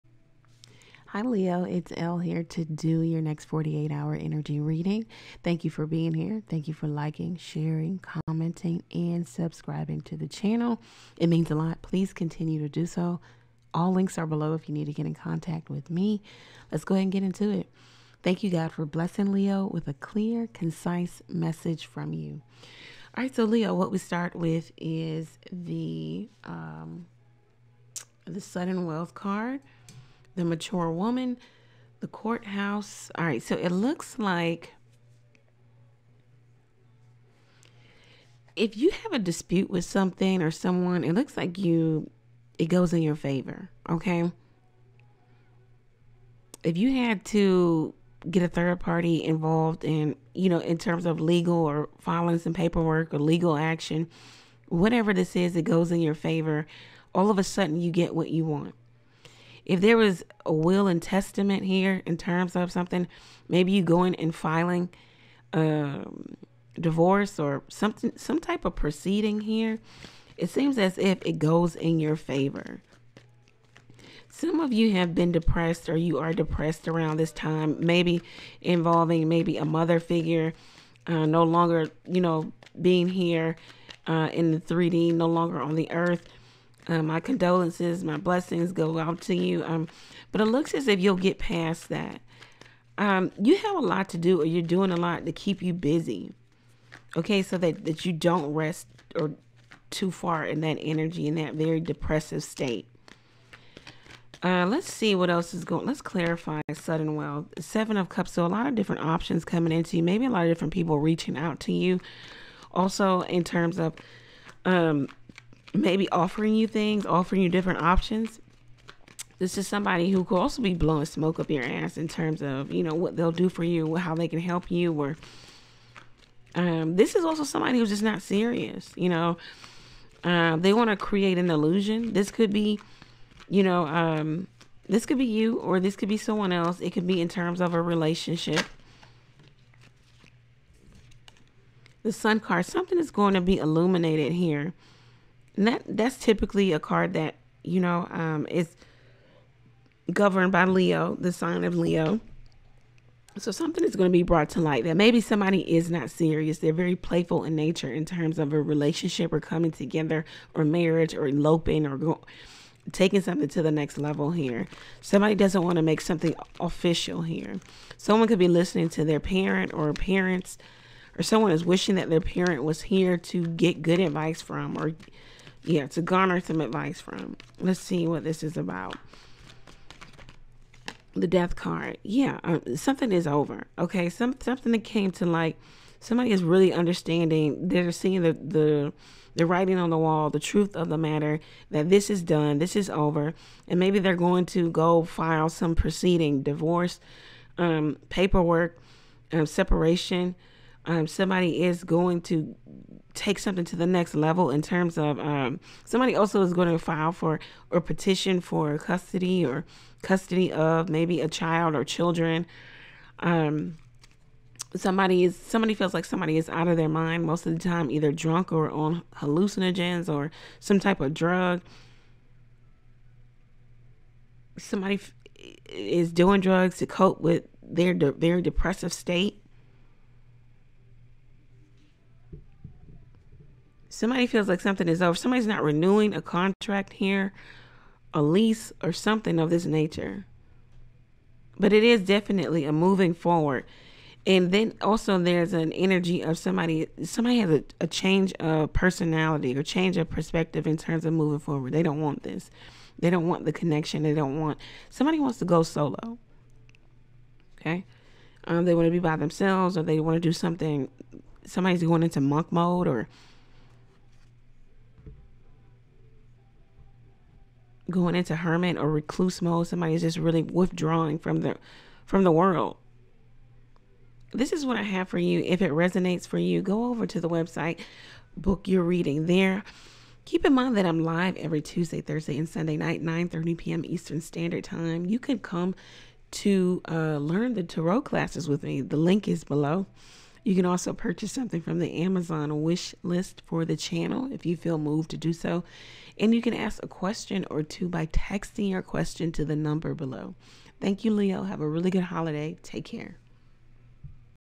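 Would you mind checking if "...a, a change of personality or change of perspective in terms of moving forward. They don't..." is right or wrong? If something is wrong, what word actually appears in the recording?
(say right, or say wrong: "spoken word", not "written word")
right.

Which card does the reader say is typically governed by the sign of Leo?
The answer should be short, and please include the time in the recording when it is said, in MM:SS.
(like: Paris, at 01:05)
The Sun, at 02:22.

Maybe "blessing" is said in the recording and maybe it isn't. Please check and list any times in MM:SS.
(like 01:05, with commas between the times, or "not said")
00:18, 01:28.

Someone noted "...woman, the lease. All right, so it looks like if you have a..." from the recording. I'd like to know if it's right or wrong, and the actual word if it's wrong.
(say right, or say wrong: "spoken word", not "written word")
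wrong: "courthouse", not "lease".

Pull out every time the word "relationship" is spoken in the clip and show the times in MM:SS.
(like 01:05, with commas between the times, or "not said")
02:17, 02:38.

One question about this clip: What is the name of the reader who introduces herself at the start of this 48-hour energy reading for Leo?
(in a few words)
Elle.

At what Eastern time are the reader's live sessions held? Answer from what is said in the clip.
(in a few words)
9:30 p.m.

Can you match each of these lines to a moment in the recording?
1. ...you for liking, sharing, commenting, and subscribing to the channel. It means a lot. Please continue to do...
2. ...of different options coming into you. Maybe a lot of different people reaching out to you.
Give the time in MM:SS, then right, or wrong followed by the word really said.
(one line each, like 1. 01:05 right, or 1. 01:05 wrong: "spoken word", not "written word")
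1. 00:06 right
2. 01:48 right.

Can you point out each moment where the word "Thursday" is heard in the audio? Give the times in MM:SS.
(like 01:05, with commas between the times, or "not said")
04:42.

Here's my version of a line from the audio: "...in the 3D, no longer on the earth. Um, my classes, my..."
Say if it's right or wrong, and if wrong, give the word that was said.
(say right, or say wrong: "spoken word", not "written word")
wrong: "condolences", not "classes".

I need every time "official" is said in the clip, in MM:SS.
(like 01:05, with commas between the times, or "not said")
02:46.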